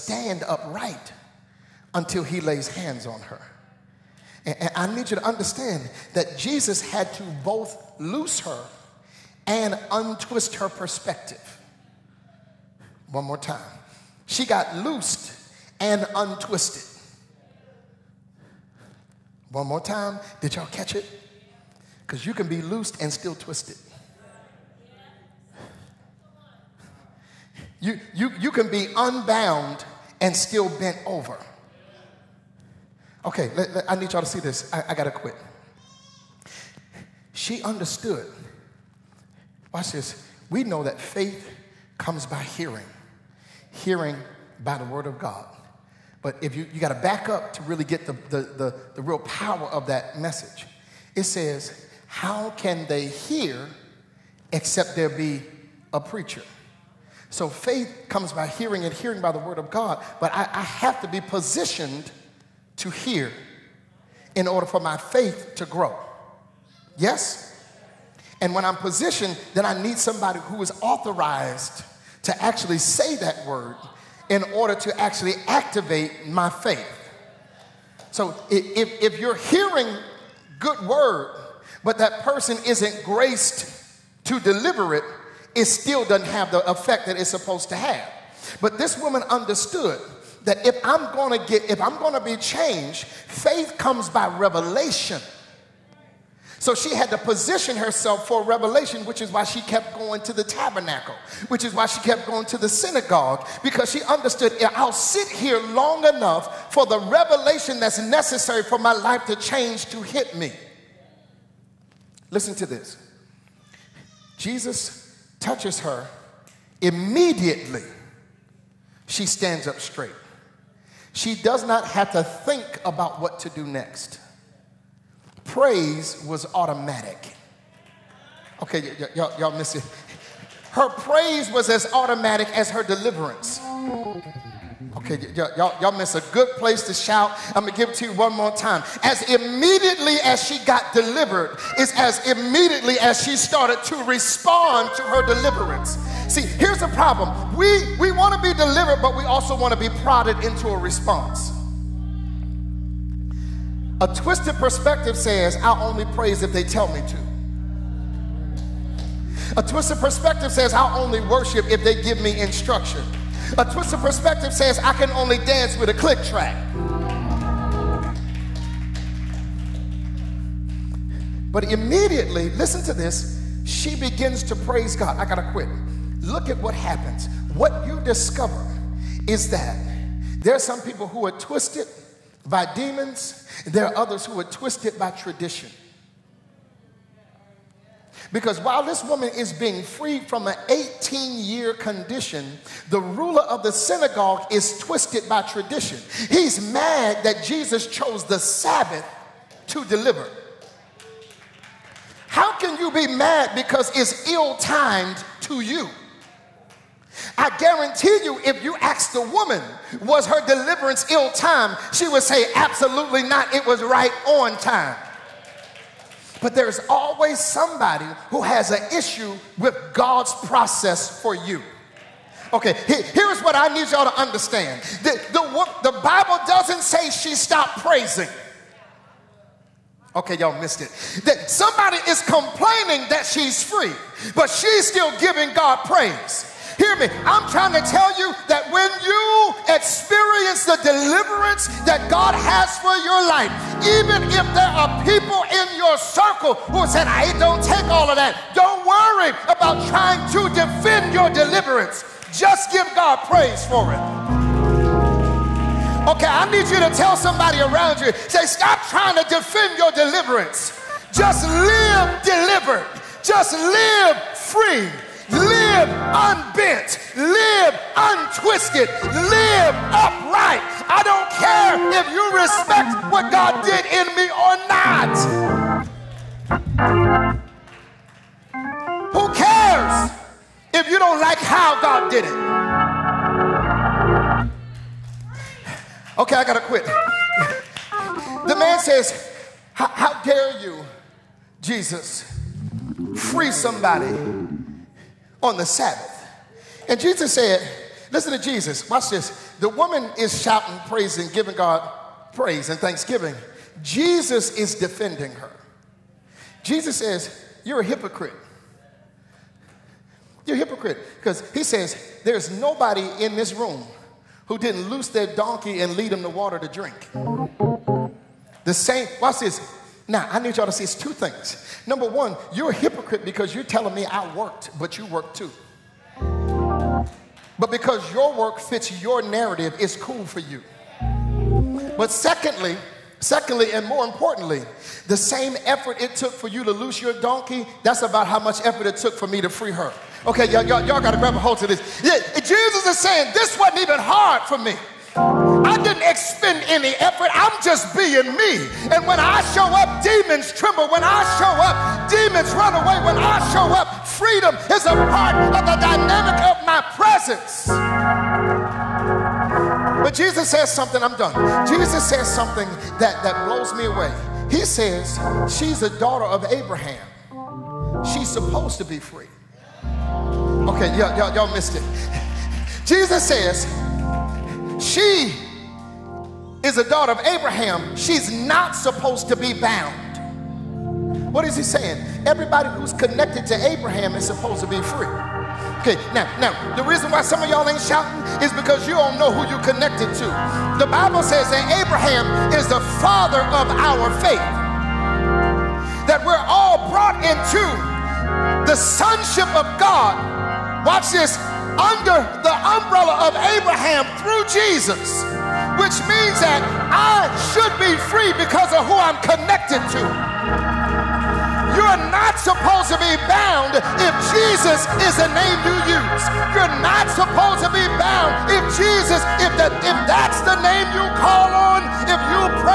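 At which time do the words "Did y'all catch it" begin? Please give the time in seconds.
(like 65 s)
20 s.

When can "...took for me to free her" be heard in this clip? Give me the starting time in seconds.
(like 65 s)
338 s.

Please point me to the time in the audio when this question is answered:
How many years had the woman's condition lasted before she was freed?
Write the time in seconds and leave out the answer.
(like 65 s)
190 s.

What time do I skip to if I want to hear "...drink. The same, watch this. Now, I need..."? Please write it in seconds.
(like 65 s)
316 s.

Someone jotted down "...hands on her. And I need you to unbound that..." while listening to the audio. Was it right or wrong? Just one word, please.
wrong.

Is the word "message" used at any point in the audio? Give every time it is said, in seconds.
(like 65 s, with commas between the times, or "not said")
50 s.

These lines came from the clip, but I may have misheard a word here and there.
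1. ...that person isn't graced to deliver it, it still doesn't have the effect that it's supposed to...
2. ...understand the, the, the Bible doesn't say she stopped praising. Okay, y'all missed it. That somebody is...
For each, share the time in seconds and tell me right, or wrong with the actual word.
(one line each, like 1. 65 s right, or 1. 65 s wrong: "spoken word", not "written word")
1. 81 s right
2. 224 s right.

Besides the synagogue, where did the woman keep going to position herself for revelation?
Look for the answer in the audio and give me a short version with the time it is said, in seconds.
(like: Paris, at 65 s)
The tabernacle, at 100 s.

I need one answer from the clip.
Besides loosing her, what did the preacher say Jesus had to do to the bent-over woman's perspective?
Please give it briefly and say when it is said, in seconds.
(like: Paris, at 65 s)
Untwist, at 9 s.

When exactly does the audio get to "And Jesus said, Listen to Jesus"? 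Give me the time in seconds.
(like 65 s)
296 s.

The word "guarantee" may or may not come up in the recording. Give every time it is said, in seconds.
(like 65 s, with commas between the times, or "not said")
207 s.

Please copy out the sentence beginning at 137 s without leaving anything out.
I'm gonna give it to you one more time.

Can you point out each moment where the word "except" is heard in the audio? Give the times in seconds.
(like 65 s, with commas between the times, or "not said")
54 s.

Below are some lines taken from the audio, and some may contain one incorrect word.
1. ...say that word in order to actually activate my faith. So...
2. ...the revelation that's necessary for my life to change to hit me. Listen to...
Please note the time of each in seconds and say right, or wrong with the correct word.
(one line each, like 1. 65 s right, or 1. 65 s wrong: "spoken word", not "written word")
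1. 72 s right
2. 106 s right.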